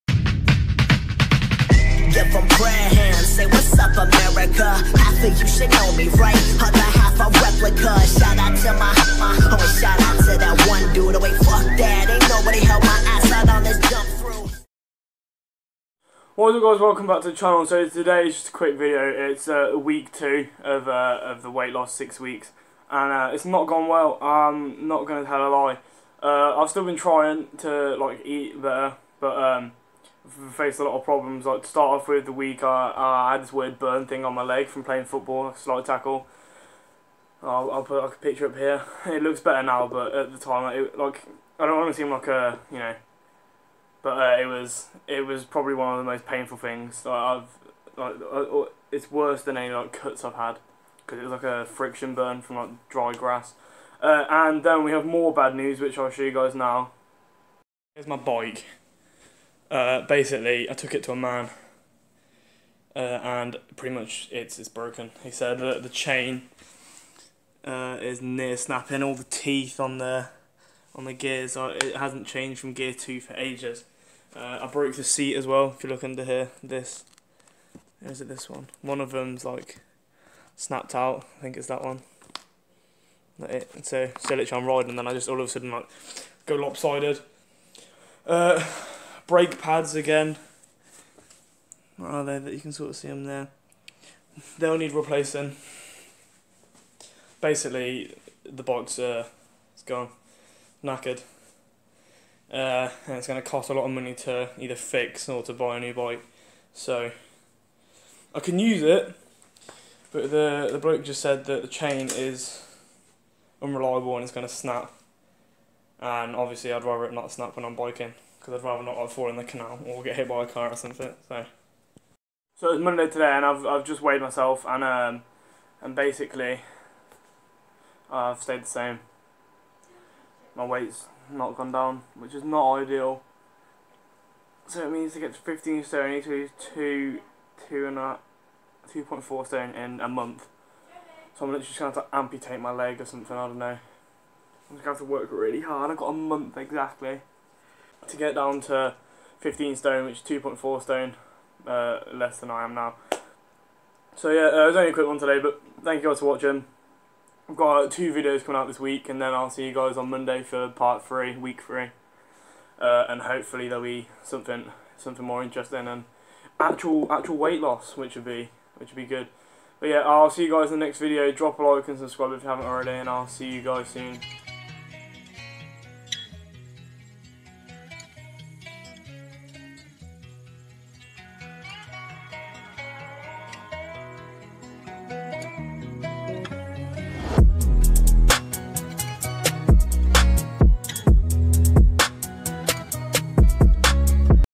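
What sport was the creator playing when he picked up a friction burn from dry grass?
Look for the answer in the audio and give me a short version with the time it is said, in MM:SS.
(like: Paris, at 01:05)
Football, at 00:35.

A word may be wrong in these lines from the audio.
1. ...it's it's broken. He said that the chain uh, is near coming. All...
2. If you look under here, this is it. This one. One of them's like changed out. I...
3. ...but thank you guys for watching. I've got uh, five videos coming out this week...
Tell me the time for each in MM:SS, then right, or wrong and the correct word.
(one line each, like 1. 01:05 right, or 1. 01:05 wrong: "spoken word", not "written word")
1. 01:04 wrong: "snapping", not "coming"
2. 01:15 wrong: "snapped", not "changed"
3. 02:35 wrong: "two", not "five".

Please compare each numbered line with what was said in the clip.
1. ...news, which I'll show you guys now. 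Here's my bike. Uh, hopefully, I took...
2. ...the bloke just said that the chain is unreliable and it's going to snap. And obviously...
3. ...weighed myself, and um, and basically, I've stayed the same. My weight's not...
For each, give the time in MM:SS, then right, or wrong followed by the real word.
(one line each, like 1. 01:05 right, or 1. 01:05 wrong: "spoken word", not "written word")
1. 00:55 wrong: "basically", not "hopefully"
2. 01:50 right
3. 02:04 right.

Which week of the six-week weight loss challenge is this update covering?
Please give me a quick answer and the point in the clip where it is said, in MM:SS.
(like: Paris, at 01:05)
Week 2, at 00:19.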